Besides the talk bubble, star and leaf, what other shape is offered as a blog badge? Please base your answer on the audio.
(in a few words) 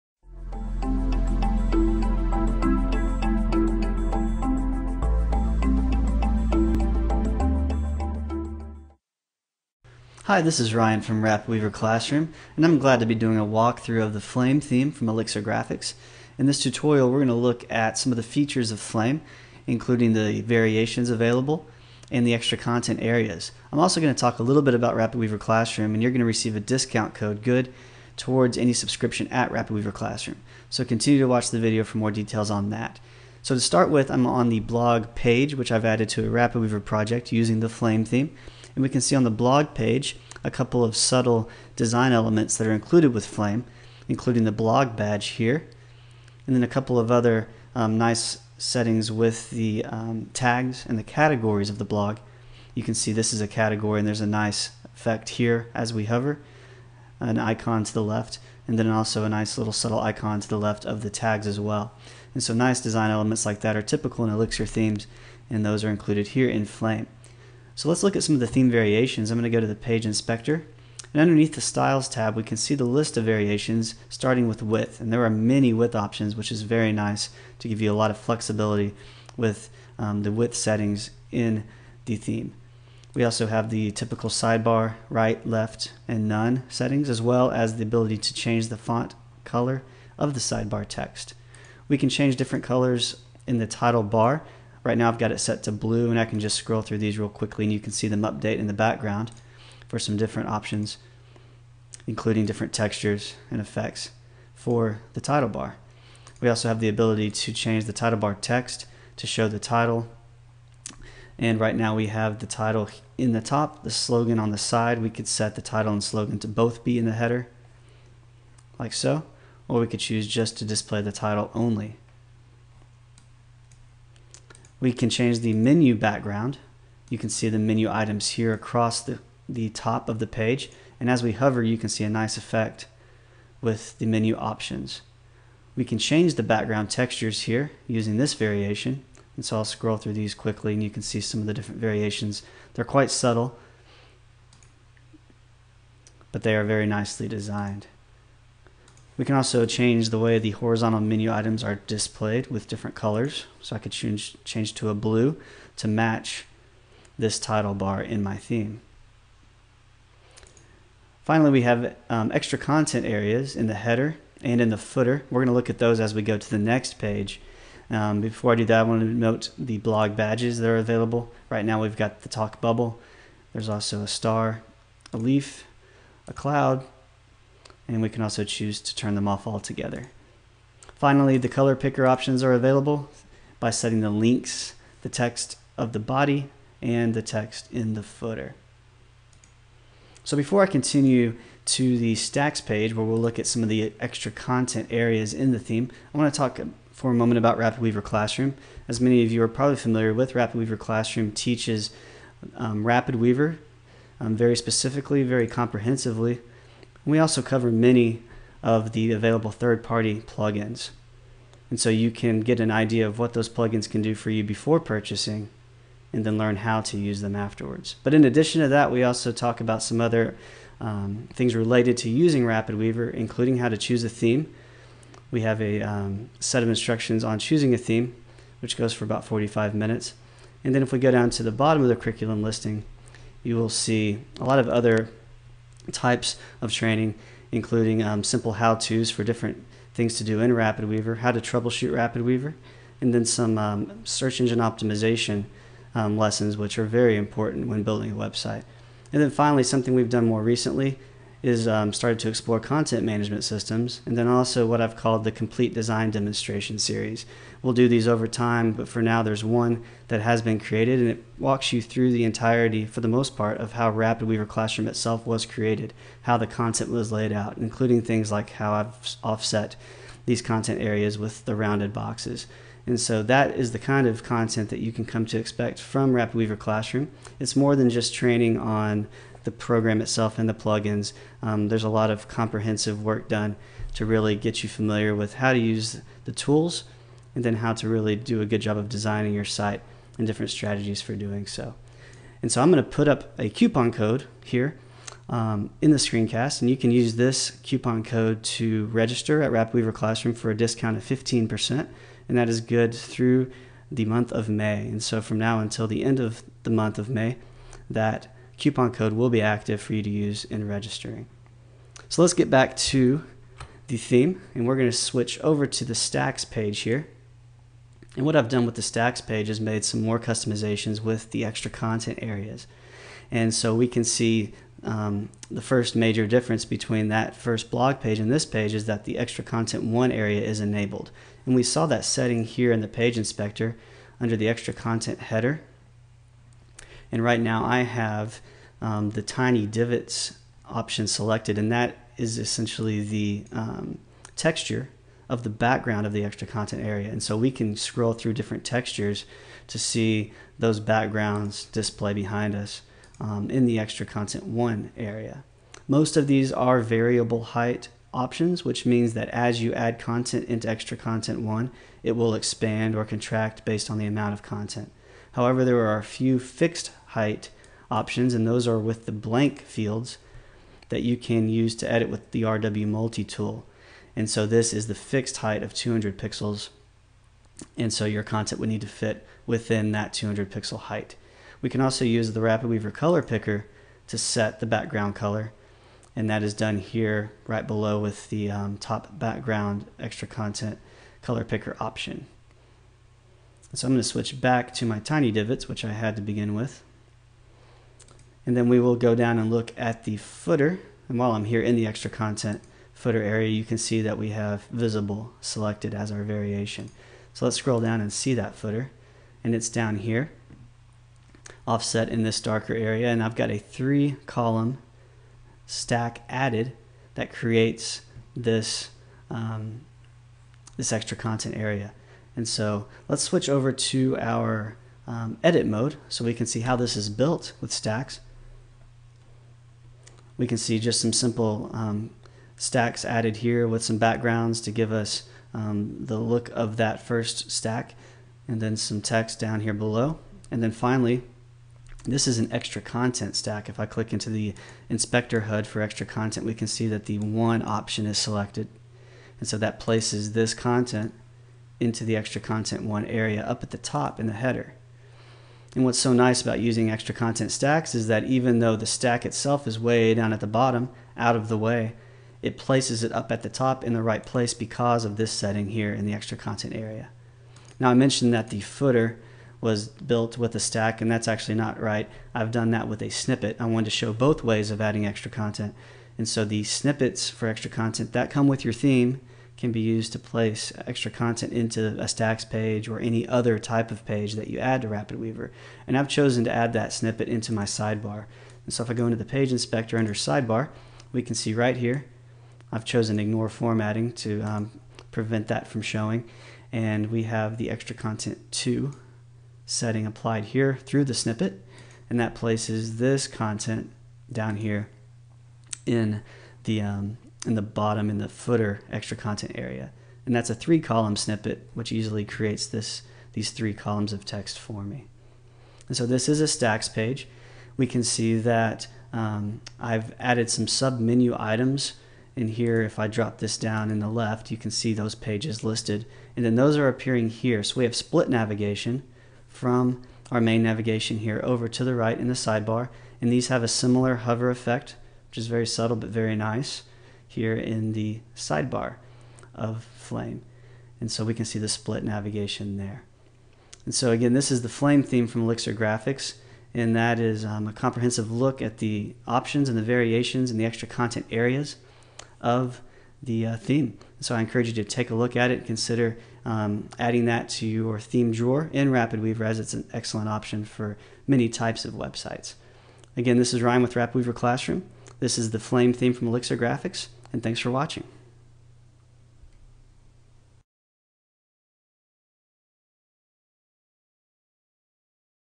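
cloud.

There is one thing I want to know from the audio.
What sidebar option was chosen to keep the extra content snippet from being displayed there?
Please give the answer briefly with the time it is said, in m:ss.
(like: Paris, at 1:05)
ignore formatting, at 8:13.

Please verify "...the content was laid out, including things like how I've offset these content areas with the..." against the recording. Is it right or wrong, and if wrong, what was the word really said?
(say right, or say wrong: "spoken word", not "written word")
right.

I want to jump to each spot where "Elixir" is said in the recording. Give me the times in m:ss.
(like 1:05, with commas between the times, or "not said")
0:15, 1:04, 9:05, 9:26.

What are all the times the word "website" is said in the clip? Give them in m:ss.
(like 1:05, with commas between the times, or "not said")
4:08, 9:21.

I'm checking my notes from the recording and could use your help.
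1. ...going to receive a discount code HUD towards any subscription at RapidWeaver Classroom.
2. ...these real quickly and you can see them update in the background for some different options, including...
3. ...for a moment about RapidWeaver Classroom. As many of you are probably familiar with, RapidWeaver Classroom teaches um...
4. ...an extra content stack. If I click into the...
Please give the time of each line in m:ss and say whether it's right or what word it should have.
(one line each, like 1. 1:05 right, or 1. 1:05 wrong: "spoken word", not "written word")
1. 0:26 wrong: "GOOD", not "HUD"
2. 1:36 right
3. 3:16 right
4. 7:22 right.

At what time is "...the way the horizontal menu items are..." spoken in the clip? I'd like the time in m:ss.
2:30.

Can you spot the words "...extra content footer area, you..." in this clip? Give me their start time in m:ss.
6:41.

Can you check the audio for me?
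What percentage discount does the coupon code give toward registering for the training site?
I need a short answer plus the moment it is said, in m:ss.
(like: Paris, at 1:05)
15%, at 5:01.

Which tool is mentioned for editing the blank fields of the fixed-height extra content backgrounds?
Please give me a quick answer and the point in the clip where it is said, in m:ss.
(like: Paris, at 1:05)
RW Multi tool, at 6:12.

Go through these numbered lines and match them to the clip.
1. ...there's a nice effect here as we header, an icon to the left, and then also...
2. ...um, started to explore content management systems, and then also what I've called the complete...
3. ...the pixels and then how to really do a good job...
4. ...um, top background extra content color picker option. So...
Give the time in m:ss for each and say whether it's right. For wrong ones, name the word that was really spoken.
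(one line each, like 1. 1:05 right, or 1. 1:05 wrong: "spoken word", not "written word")
1. 0:54 wrong: "hover", not "header"
2. 4:11 right
3. 4:46 wrong: "tools", not "pixels"
4. 6:28 right.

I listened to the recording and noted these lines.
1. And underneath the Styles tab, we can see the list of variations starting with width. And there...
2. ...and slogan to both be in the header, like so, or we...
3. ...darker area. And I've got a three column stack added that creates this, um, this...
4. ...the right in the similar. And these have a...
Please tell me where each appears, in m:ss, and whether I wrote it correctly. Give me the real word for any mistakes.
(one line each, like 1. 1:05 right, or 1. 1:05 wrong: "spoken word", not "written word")
1. 1:11 right
2. 1:55 right
3. 6:52 right
4. 8:51 wrong: "sidebar", not "similar".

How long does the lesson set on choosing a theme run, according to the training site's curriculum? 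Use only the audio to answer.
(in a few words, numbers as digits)
45 minutes.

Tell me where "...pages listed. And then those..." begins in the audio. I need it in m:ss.
8:45.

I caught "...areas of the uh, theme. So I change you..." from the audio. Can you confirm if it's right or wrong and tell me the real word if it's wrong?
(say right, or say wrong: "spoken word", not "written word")
wrong: "encourage", not "change".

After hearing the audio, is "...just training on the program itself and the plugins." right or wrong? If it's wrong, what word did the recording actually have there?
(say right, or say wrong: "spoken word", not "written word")
right.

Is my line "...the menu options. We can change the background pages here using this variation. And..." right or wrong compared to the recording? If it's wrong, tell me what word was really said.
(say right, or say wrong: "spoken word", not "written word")
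wrong: "textures", not "pages".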